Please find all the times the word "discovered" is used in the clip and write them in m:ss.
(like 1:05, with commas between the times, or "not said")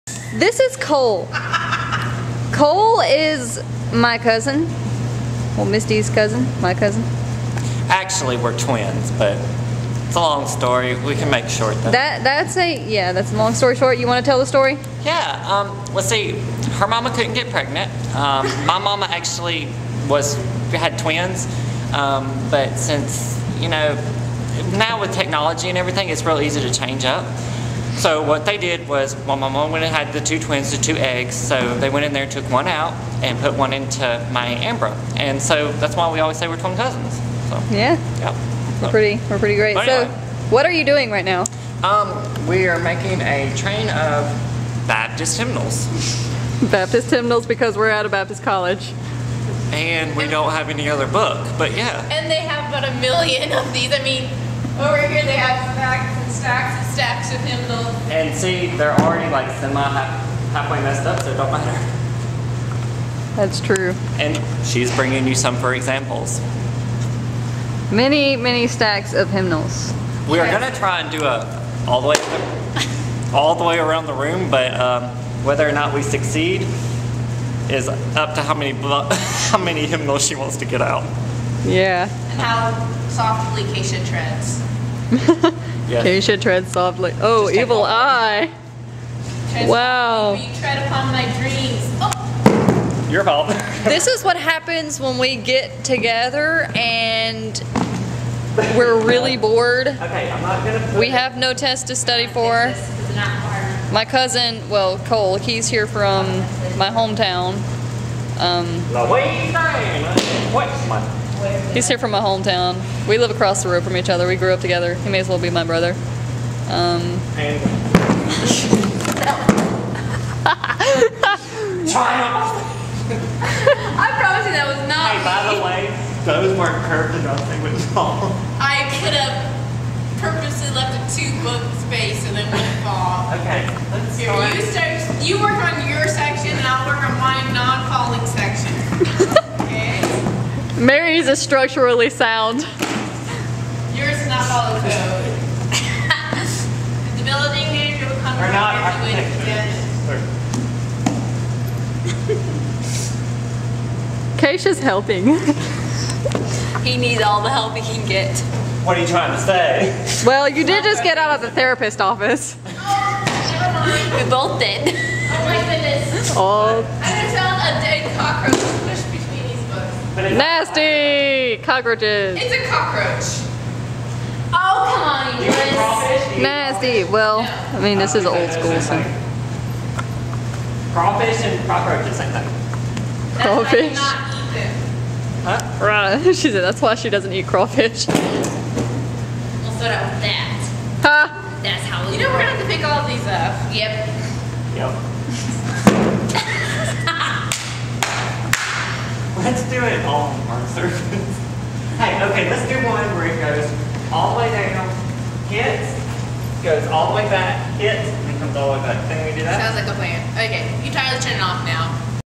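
not said.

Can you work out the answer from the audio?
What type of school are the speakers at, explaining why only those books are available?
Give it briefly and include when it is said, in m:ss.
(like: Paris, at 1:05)
Baptist college, at 0:48.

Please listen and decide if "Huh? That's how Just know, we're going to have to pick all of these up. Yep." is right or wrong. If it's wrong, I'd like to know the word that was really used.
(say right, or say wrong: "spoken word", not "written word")
wrong: "You", not "Just".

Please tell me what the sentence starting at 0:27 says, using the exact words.
So what they did was, well, my mom went and had the two twins, the two eggs.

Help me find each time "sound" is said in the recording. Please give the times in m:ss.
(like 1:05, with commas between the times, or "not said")
2:22, 3:29.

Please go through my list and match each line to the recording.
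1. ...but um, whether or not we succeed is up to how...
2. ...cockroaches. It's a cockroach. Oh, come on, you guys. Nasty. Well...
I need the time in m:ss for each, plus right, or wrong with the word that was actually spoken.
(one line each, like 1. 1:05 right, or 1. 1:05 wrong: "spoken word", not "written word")
1. 1:14 right
2. 2:51 right.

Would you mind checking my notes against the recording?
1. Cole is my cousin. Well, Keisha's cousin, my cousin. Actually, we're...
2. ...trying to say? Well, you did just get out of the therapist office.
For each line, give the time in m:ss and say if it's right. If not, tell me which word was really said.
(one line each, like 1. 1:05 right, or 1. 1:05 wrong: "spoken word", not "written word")
1. 0:02 wrong: "Misty", not "Keisha"
2. 2:39 right.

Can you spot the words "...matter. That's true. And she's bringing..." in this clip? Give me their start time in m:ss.
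1:01.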